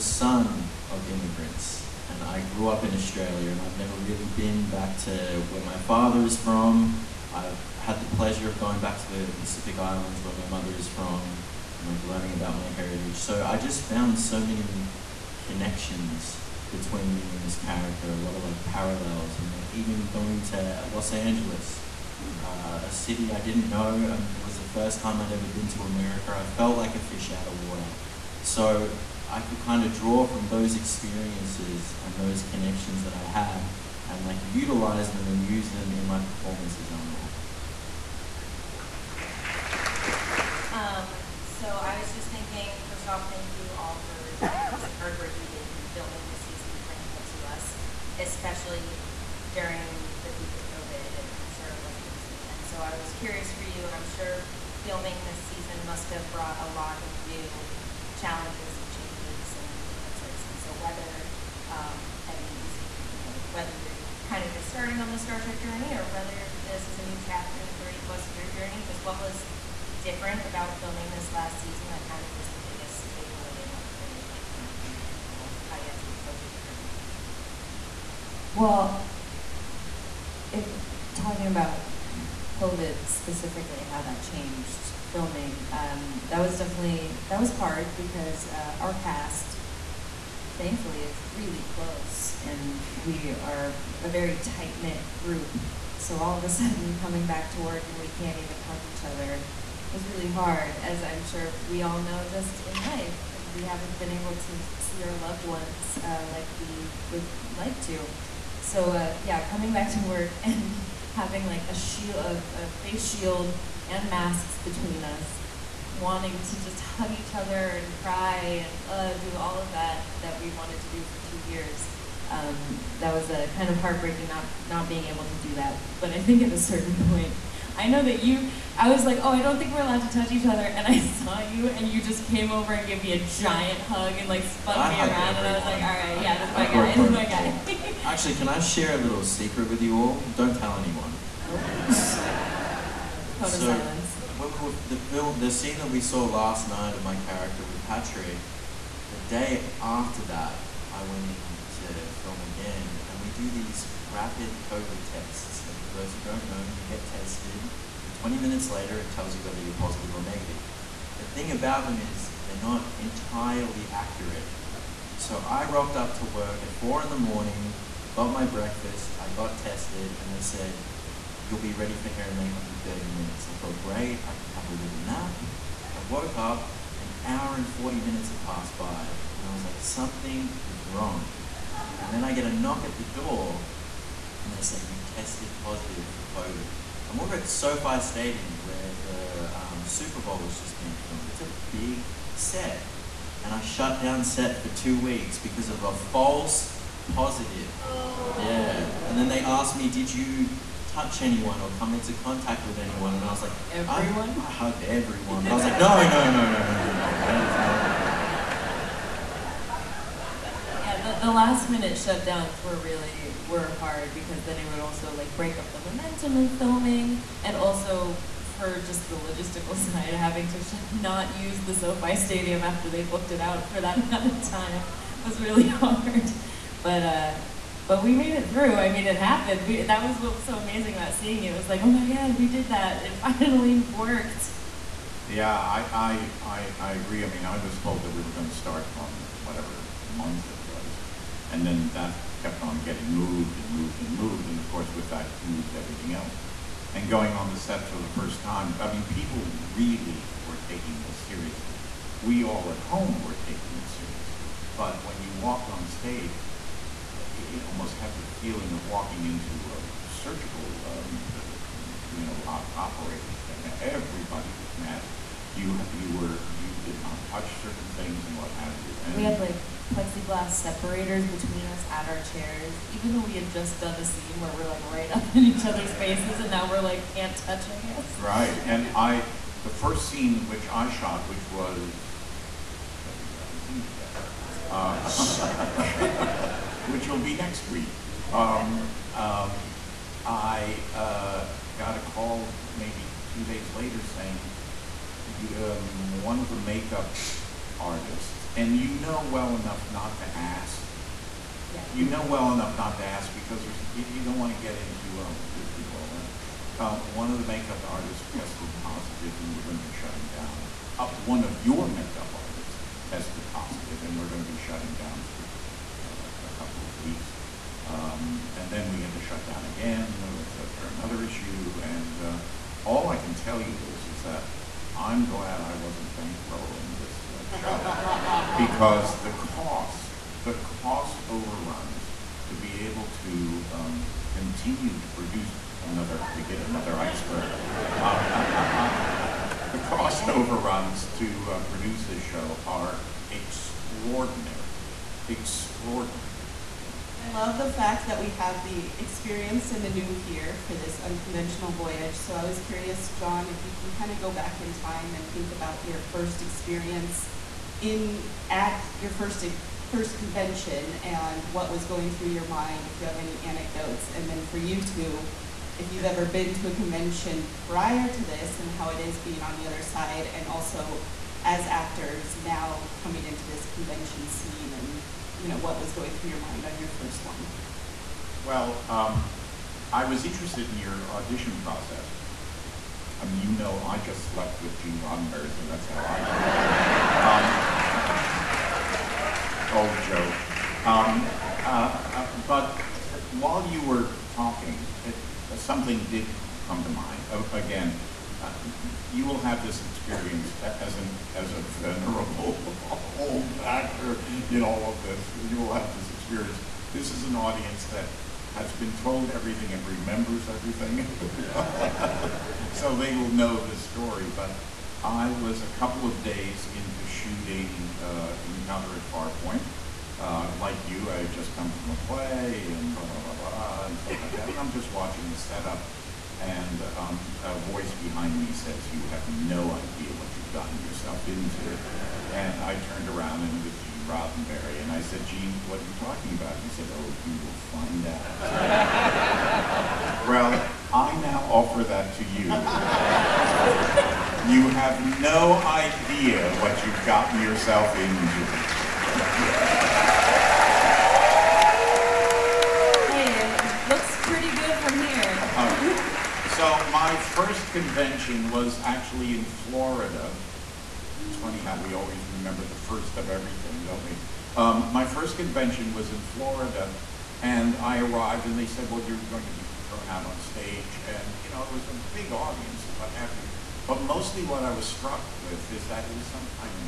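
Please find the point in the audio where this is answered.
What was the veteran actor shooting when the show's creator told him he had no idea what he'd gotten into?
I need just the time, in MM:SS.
06:58.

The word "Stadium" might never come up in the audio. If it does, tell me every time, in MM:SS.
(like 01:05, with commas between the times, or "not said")
03:07, 03:42.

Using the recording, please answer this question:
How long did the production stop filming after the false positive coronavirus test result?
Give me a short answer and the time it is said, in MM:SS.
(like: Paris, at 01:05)
two weeks, at 03:14.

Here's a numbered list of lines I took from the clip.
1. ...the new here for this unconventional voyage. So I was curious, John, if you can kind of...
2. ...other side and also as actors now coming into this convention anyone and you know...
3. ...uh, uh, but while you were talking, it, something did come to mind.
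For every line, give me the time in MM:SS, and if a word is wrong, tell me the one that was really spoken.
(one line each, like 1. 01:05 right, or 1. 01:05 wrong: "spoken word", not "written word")
1. 05:49 right
2. 06:09 wrong: "scene", not "anyone"
3. 06:31 right.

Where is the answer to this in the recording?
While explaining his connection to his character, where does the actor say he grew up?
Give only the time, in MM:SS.
00:02.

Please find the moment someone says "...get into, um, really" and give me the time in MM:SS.
05:04.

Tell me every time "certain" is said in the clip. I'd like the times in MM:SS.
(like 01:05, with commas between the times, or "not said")
02:06, 04:27.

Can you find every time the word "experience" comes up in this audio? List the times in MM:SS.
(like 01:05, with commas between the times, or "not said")
00:30, 05:48, 05:56, 06:39, 06:46.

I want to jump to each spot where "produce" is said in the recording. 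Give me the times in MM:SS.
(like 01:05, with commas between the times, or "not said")
05:35, 05:41.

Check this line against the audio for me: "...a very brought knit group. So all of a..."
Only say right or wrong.
wrong.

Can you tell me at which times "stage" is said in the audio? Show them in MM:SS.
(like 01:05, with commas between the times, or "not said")
04:15, 07:50.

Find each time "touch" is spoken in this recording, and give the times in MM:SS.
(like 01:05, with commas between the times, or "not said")
02:10, 03:20, 04:27, 04:37.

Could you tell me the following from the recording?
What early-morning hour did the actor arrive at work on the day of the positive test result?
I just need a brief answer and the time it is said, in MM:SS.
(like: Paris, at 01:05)
four in the morning, at 02:46.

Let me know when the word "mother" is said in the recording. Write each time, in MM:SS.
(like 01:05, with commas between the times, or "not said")
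00:10.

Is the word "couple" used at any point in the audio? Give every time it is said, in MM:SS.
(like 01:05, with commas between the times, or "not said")
05:16, 06:55.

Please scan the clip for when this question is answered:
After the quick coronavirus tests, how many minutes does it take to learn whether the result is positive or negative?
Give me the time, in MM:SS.
02:38.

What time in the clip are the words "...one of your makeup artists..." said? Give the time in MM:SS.
05:11.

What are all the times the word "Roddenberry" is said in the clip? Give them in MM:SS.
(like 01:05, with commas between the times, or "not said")
06:25, 07:14.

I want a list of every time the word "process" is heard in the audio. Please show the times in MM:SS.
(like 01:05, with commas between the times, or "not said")
06:21.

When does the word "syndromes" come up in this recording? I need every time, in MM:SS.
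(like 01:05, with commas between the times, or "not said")
not said.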